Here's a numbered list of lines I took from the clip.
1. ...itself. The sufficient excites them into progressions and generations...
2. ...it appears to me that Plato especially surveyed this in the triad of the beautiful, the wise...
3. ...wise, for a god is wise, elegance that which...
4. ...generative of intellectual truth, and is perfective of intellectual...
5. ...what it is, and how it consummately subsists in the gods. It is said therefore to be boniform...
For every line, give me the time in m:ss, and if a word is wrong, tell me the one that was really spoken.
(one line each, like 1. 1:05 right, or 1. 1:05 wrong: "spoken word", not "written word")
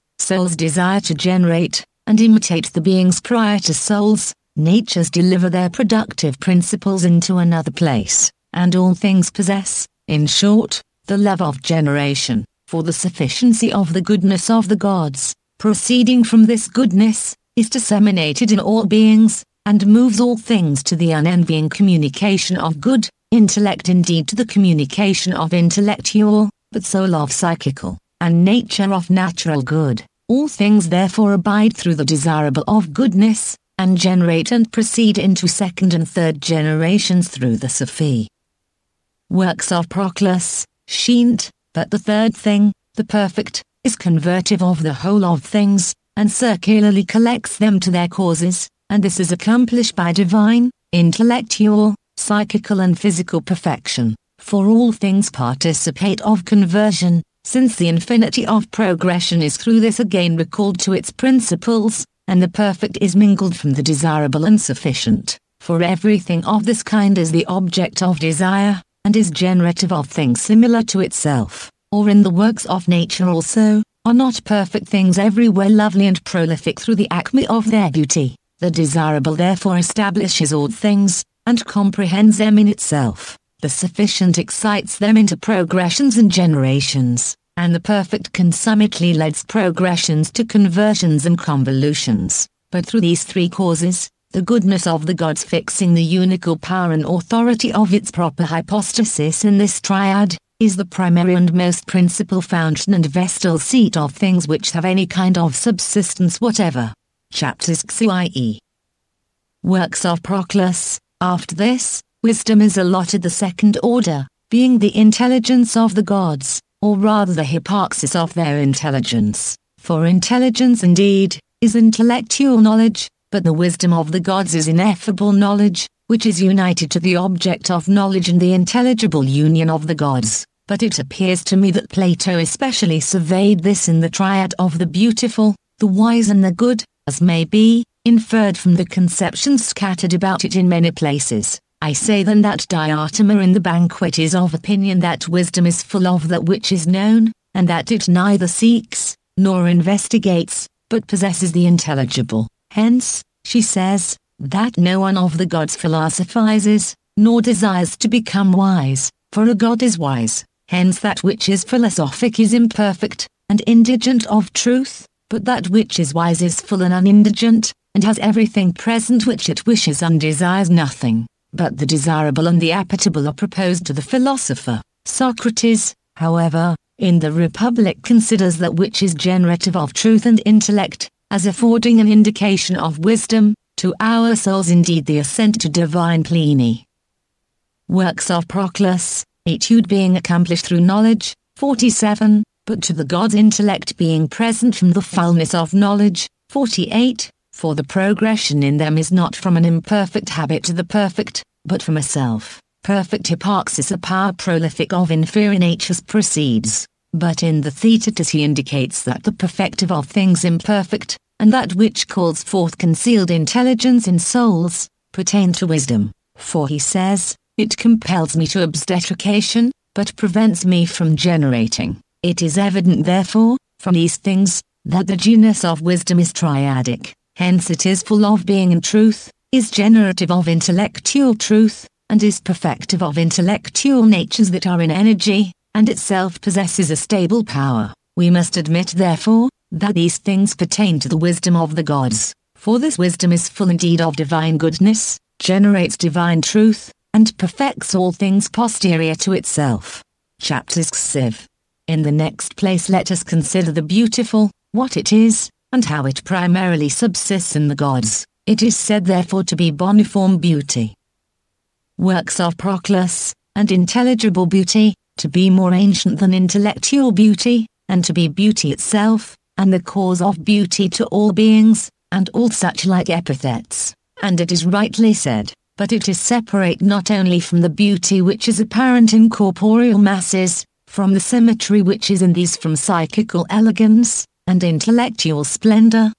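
1. 1:22 right
2. 2:10 right
3. 2:38 wrong: "hence", not "elegance"
4. 3:49 right
5. 4:14 wrong: "primarily", not "consummately".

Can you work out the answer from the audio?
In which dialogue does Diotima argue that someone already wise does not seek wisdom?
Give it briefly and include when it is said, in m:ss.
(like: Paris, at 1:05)
The Banquet, at 2:23.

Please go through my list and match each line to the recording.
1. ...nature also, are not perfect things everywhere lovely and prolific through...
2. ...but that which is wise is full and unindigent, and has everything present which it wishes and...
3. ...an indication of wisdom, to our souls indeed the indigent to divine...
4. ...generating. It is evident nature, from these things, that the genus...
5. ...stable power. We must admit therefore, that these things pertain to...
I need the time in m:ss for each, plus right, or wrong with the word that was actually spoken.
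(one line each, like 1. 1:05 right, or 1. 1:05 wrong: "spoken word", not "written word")
1. 1:12 right
2. 2:45 right
3. 3:01 wrong: "ascent", not "indigent"
4. 3:41 wrong: "therefore", not "nature"
5. 3:56 right.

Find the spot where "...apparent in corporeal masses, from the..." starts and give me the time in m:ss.
4:38.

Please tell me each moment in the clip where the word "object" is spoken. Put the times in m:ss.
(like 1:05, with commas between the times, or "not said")
1:07, 2:07.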